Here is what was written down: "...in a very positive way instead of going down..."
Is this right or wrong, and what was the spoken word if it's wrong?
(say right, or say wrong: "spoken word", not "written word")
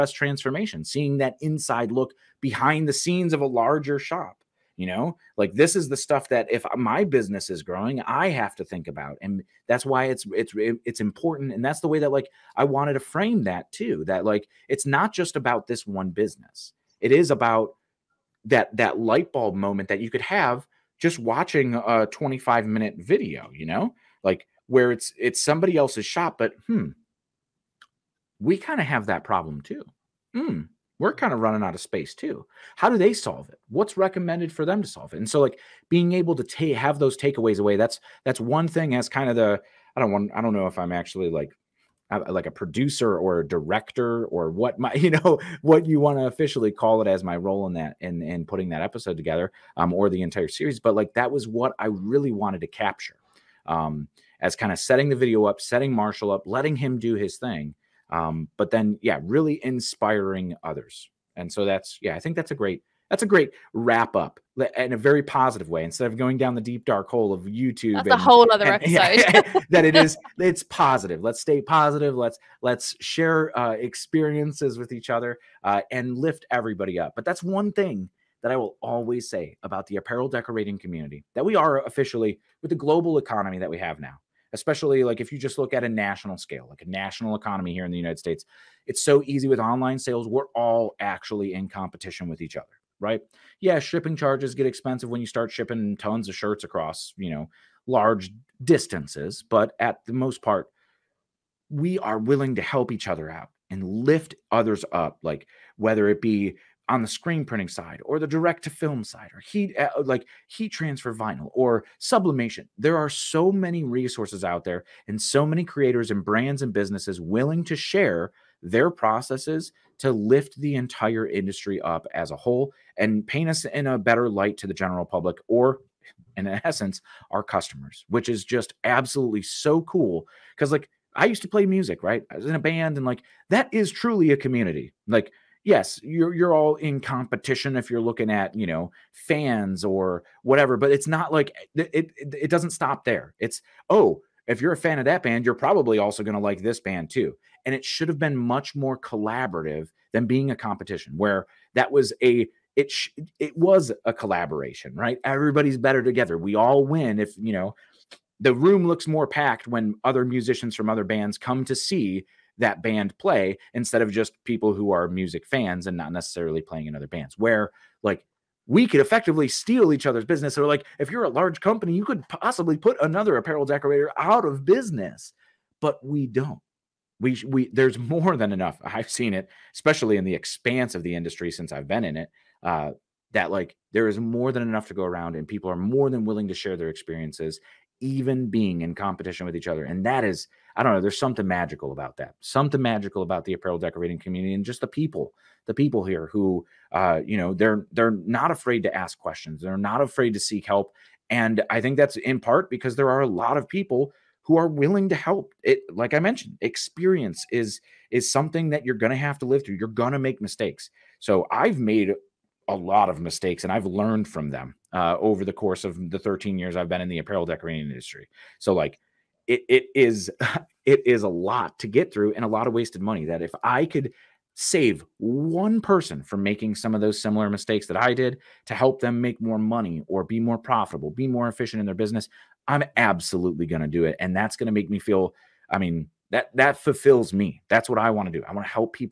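right.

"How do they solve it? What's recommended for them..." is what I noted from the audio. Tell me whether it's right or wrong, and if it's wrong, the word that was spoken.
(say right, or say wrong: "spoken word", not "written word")
right.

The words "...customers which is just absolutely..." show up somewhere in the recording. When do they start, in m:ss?
2:07.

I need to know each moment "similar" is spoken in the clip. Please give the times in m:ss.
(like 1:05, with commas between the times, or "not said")
3:47.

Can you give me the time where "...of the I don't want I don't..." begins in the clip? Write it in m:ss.
0:39.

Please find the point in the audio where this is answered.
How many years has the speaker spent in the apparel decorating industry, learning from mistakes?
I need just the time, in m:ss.
3:36.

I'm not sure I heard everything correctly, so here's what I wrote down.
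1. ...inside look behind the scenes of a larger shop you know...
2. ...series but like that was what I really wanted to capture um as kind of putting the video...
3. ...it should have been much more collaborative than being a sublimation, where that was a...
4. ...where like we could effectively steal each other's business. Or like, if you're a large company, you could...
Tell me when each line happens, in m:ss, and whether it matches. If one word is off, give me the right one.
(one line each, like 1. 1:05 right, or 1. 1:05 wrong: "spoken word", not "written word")
1. 0:01 right
2. 0:50 wrong: "setting", not "putting"
3. 2:27 wrong: "competition", not "sublimation"
4. 2:47 right.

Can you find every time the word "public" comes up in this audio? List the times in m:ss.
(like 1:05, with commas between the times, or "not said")
2:05.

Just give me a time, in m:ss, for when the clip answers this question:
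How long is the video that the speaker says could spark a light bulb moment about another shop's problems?
0:22.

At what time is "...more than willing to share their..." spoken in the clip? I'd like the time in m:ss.
3:05.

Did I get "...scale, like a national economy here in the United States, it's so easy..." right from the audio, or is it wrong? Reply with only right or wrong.
right.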